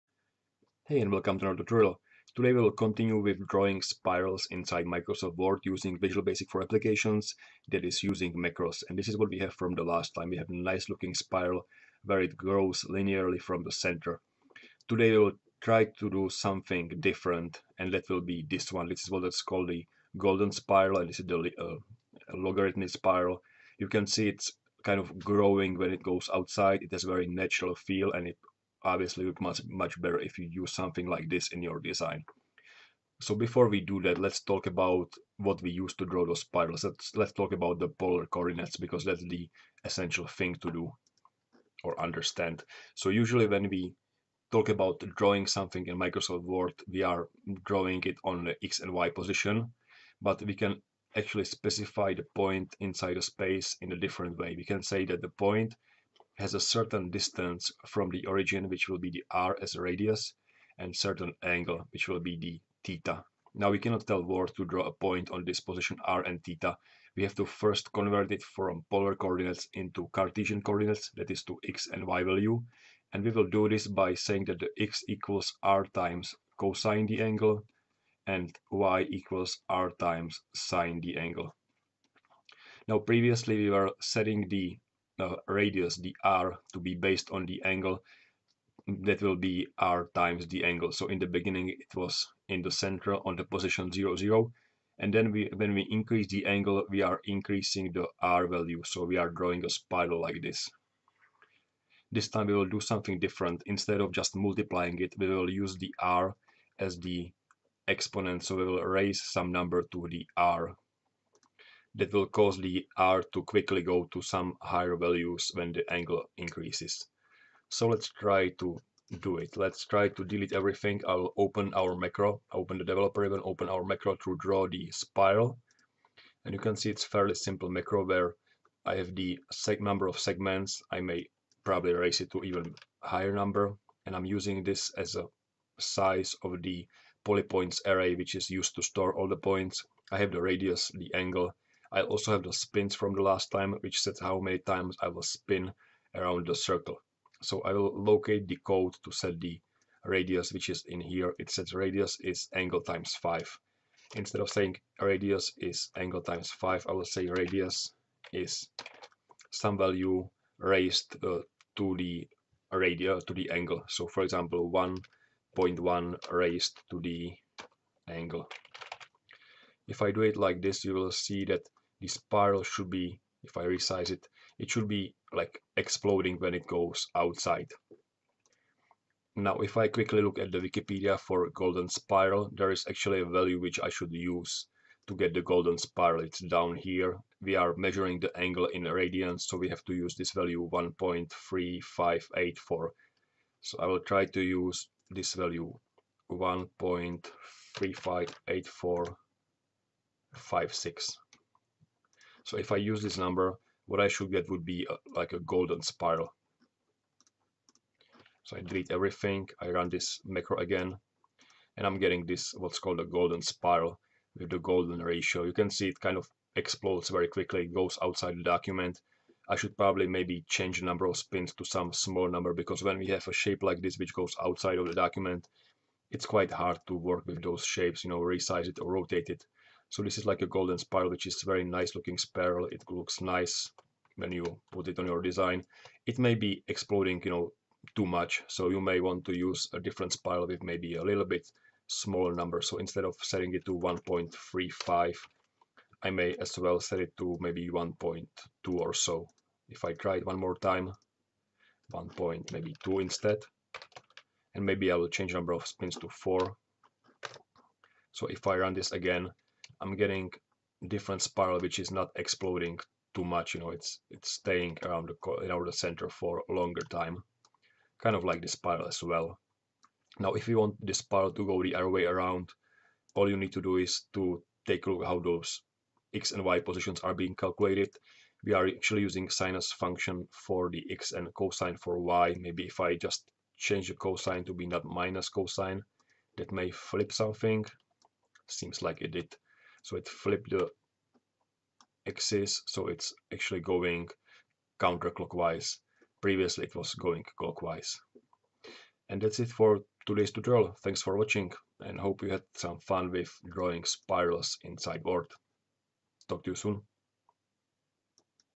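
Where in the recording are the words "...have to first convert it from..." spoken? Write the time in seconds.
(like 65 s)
67 s.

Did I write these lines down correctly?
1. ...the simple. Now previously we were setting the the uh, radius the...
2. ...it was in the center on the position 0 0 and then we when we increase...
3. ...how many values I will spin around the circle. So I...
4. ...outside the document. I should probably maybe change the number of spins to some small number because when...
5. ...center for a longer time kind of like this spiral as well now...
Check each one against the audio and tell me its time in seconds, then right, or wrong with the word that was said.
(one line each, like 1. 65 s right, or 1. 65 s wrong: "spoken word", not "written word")
1. 81 s wrong: "angle", not "simple"
2. 91 s right
3. 144 s wrong: "times", not "values"
4. 218 s right
5. 265 s right.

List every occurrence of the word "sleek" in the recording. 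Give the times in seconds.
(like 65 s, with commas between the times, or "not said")
not said.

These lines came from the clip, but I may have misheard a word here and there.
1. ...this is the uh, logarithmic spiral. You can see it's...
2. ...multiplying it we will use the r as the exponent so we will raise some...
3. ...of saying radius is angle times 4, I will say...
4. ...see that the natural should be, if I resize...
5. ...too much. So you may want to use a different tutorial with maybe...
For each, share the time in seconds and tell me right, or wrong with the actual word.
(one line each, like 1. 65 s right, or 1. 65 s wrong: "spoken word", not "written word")
1. 21 s right
2. 104 s right
3. 154 s wrong: "5", not "4"
4. 171 s wrong: "spiral", not "natural"
5. 237 s wrong: "spiral", not "tutorial".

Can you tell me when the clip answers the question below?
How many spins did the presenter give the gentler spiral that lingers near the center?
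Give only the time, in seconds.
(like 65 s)
256 s.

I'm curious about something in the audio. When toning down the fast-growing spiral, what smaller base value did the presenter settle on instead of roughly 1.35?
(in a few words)
1.2.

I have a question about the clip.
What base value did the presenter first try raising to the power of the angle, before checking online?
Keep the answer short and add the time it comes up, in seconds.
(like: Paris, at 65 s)
1.1, at 164 s.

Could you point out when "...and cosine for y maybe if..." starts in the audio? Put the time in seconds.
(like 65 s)
281 s.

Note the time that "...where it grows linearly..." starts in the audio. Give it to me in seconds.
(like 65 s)
12 s.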